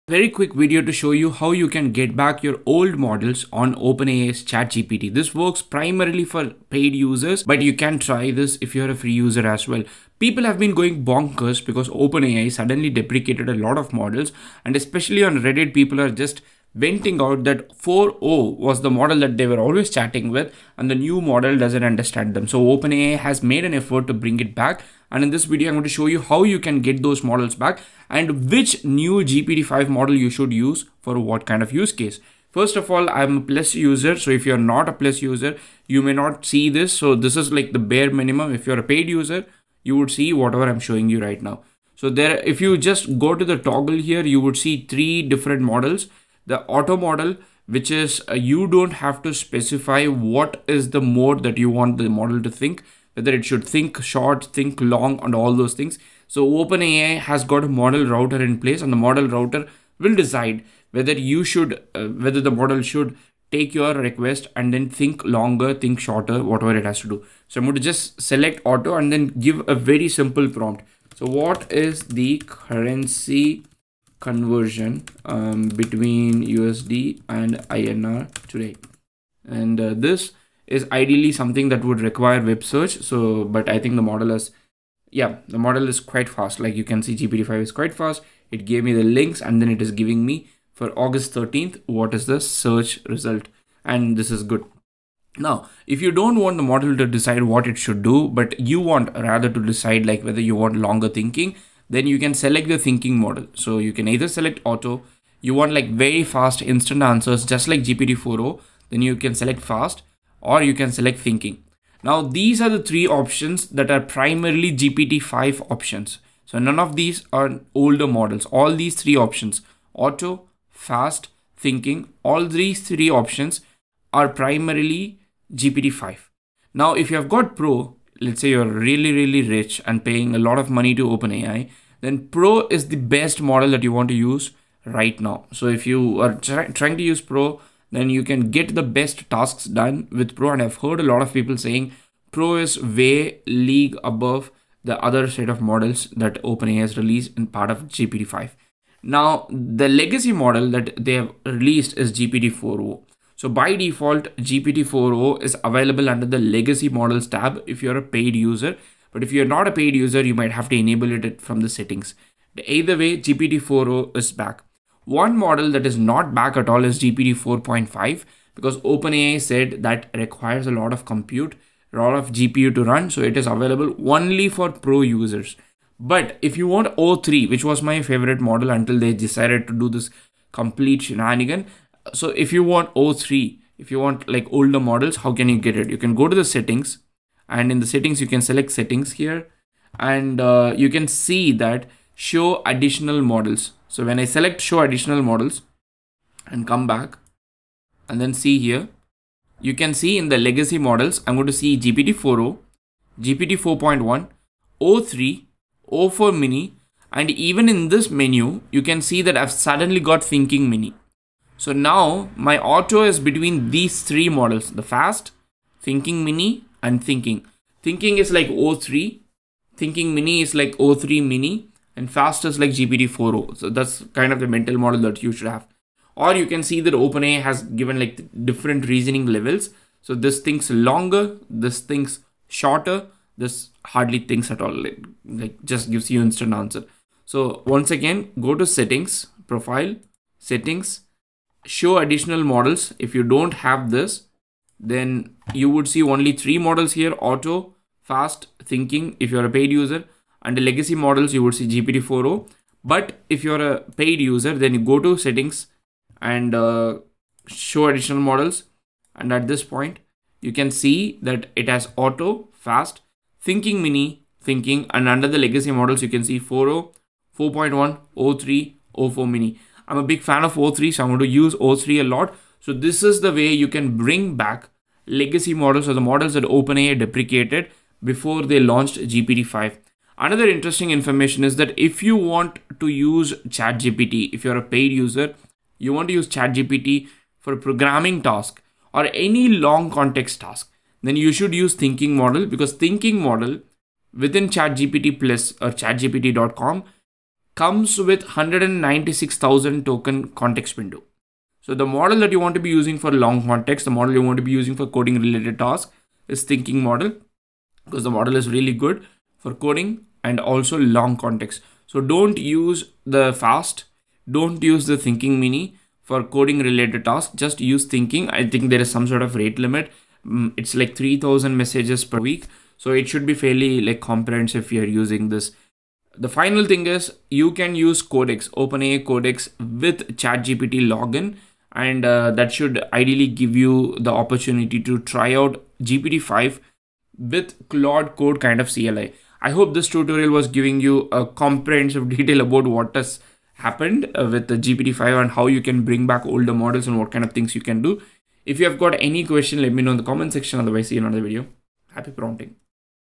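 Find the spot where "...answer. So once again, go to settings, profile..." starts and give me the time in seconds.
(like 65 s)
236 s.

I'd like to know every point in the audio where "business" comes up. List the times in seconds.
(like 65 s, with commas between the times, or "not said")
not said.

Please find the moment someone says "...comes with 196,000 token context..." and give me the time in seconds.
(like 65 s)
297 s.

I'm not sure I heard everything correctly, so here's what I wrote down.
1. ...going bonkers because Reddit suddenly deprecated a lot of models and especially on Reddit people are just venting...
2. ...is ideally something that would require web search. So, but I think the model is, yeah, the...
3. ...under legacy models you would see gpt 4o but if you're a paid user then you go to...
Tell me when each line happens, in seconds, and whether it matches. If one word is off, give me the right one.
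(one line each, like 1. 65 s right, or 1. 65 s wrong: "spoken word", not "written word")
1. 10 s wrong: "OpenAI", not "Reddit"
2. 80 s right
3. 250 s right.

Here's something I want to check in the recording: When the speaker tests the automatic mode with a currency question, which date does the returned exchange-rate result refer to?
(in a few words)
August 13th.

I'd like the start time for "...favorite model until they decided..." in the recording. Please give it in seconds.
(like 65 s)
178 s.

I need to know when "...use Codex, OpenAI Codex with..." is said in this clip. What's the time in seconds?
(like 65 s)
327 s.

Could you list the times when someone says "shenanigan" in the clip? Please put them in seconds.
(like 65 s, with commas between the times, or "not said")
181 s.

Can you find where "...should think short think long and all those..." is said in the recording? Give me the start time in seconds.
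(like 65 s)
53 s.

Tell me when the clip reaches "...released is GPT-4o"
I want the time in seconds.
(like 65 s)
151 s.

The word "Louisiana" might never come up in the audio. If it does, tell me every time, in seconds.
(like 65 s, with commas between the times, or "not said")
not said.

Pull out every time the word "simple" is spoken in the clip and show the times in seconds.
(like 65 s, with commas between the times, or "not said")
70 s.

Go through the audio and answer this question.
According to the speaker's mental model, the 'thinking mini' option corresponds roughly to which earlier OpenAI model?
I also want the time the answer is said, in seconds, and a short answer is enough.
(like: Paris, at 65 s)
O3 mini, at 220 s.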